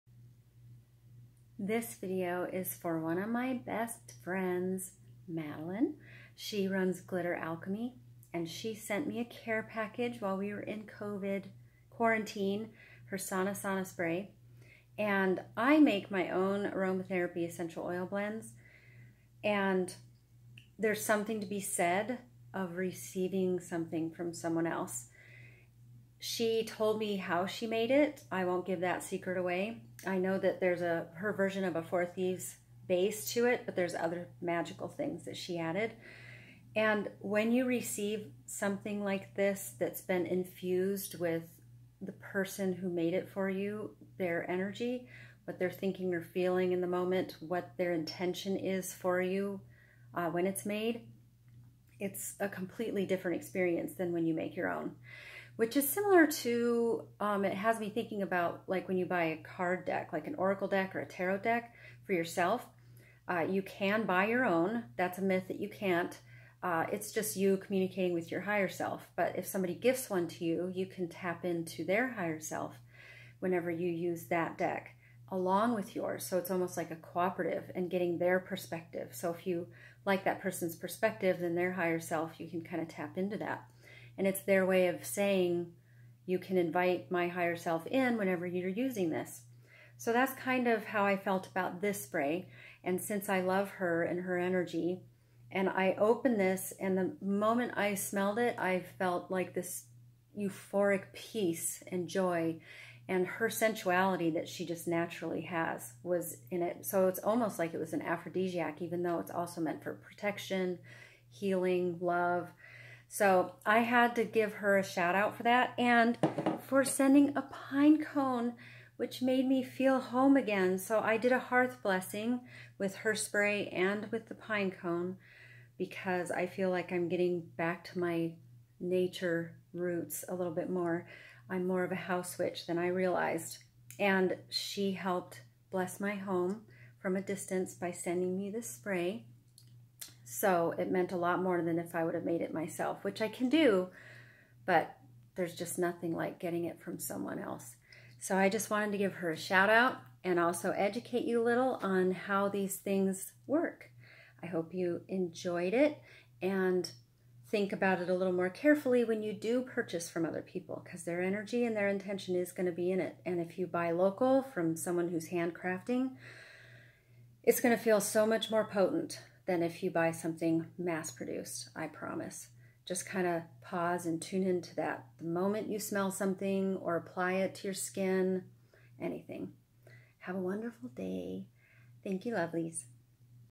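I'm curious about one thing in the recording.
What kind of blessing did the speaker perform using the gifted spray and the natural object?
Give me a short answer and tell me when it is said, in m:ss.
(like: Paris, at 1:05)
hearth blessing, at 2:01.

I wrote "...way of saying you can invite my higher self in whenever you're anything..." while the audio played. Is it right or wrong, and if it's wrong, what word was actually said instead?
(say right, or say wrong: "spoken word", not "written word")
wrong: "using", not "anything".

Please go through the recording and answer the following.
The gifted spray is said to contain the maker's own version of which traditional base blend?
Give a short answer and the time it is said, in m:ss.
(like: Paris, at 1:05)
Four Thieves, at 0:31.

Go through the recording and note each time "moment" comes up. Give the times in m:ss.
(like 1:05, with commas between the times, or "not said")
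0:46, 1:37, 2:55.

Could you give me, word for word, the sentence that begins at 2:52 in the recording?
Just kind of pause and tune into that.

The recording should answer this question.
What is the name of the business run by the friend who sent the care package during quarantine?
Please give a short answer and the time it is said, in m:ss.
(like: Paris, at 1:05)
Glitter Alchemy, at 0:07.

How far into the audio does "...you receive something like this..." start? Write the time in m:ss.
0:37.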